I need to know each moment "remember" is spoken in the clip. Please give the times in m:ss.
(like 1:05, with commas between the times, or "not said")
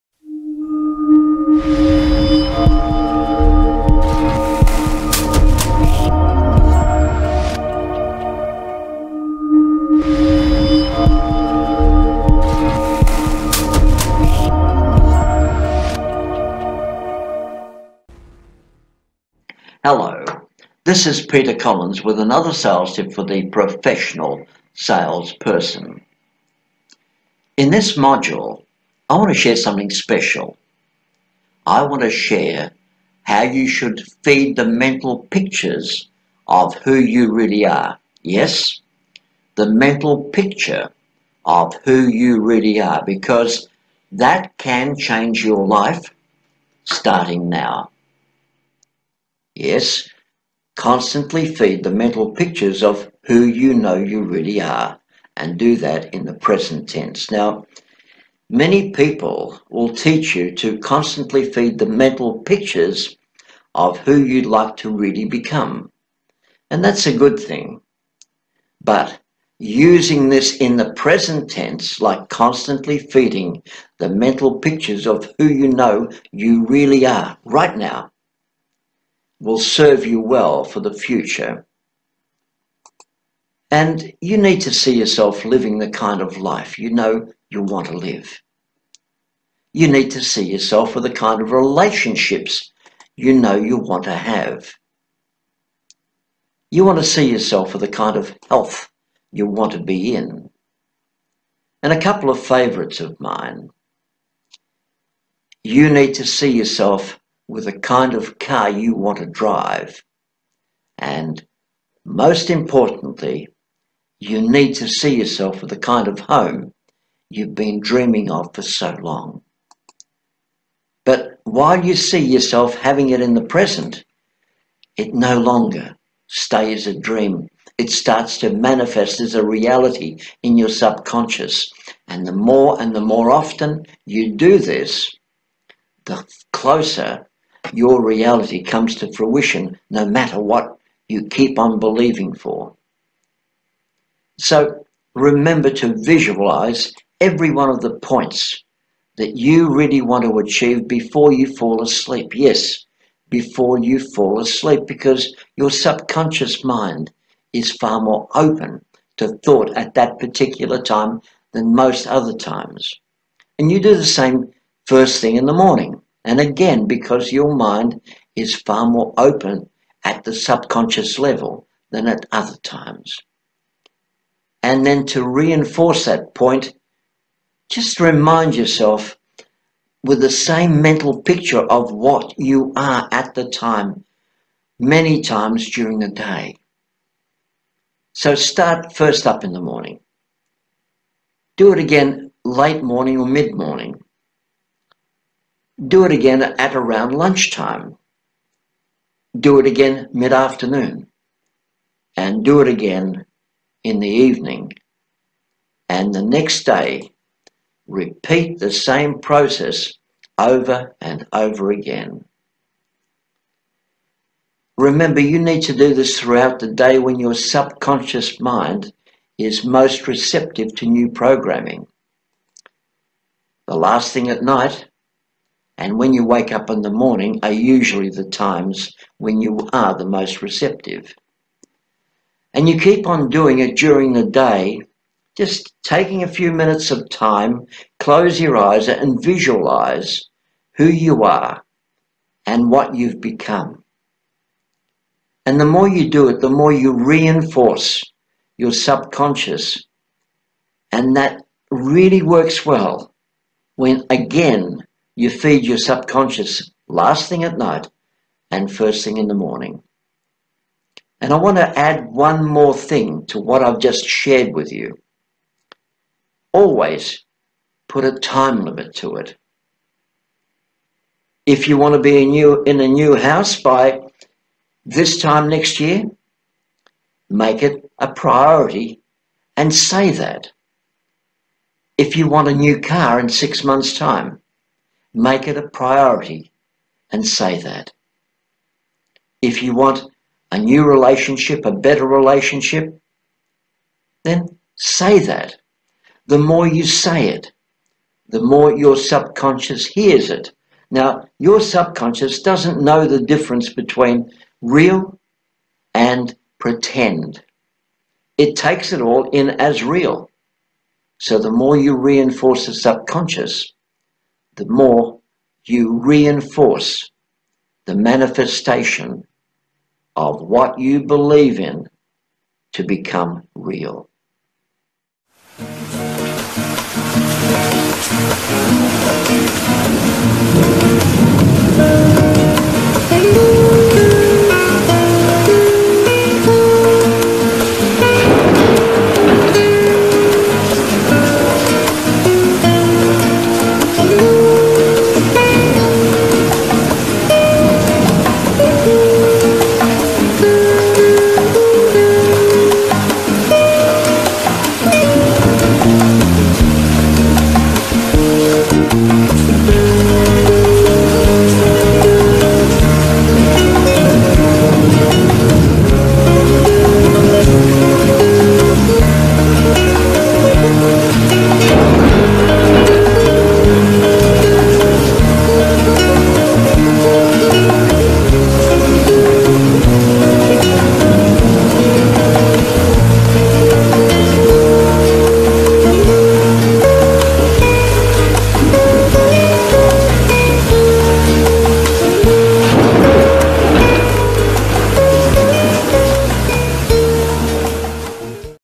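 2:25, 3:34.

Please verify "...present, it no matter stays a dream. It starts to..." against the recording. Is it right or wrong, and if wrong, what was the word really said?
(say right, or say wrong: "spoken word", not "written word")
wrong: "longer", not "matter".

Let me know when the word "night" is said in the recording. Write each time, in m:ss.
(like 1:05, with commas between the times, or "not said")
3:44, 4:17.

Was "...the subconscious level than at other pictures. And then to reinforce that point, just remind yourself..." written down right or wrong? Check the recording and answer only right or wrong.
wrong.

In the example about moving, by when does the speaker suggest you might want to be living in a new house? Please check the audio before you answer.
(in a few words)
this time next year.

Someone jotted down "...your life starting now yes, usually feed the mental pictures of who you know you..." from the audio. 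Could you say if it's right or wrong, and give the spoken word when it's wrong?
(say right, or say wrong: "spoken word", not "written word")
wrong: "constantly", not "usually".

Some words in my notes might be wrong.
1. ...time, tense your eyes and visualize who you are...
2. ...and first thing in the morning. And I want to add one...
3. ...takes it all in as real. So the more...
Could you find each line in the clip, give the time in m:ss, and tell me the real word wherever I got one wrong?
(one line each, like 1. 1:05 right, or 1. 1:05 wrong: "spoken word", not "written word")
1. 3:57 wrong: "close", not "tense"
2. 4:18 right
3. 5:08 right.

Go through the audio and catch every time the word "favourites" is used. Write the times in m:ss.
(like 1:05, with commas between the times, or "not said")
1:42.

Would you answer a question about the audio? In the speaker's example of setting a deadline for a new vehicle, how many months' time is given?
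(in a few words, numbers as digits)
6.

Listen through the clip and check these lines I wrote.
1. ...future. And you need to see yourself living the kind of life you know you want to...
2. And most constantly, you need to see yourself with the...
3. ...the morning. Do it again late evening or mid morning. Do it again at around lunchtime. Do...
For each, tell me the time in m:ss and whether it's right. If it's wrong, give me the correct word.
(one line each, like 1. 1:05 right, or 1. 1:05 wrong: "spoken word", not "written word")
1. 1:20 right
2. 1:50 wrong: "importantly", not "constantly"
3. 3:09 wrong: "morning", not "evening".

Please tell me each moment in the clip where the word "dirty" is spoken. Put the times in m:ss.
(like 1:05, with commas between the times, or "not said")
not said.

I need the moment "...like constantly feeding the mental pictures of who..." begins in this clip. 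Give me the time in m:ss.
1:12.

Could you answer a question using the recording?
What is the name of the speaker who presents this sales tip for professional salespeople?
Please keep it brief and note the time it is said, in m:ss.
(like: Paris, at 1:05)
Peter Collins, at 0:21.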